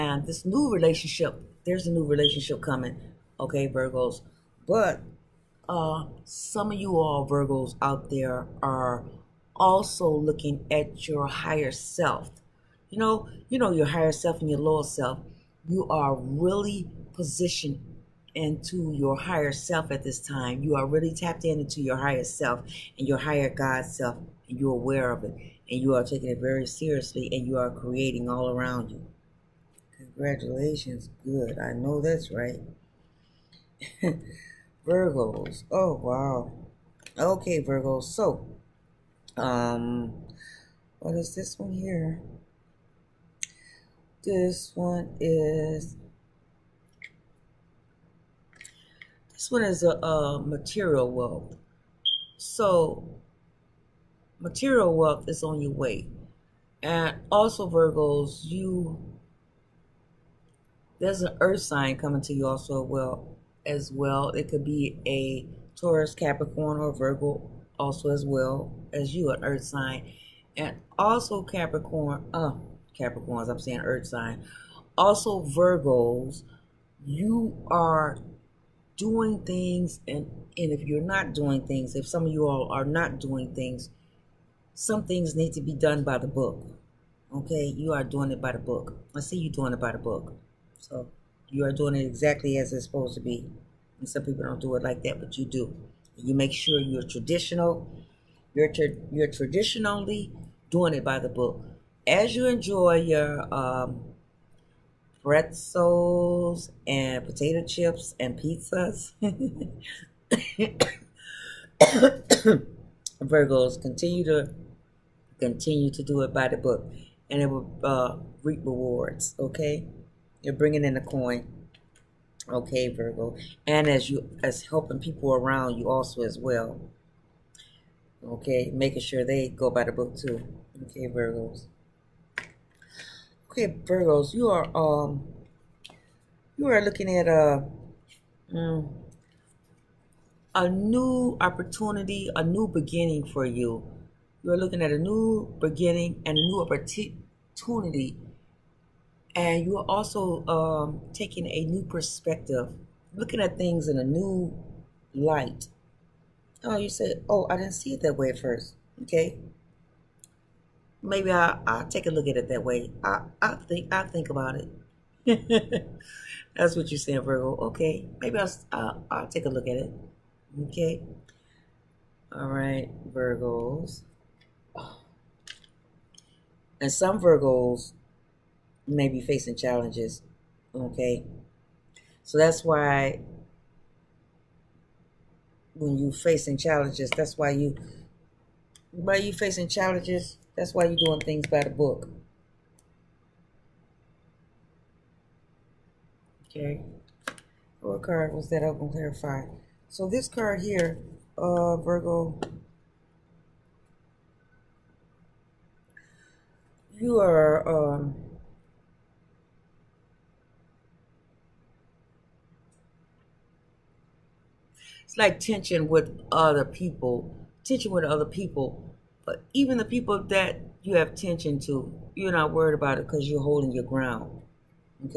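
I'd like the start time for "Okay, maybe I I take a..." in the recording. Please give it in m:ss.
2:39.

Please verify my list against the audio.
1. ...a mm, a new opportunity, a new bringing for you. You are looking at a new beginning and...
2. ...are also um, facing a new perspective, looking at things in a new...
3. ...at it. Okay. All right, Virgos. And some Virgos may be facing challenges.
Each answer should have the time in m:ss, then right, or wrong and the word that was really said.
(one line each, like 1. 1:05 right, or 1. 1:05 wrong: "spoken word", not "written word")
1. 2:17 wrong: "beginning", not "bringing"
2. 2:29 wrong: "taking", not "facing"
3. 2:49 right.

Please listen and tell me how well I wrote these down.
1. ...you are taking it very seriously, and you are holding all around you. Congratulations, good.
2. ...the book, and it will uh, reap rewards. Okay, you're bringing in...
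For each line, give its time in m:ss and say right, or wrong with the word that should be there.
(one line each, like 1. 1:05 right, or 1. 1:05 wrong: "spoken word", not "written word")
1. 0:25 wrong: "creating", not "holding"
2. 1:56 right.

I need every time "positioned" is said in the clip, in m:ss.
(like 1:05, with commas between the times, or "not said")
0:17.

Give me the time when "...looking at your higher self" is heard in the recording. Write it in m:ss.
0:10.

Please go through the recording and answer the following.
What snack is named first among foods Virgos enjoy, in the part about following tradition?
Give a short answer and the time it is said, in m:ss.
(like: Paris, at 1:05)
pretzels, at 1:45.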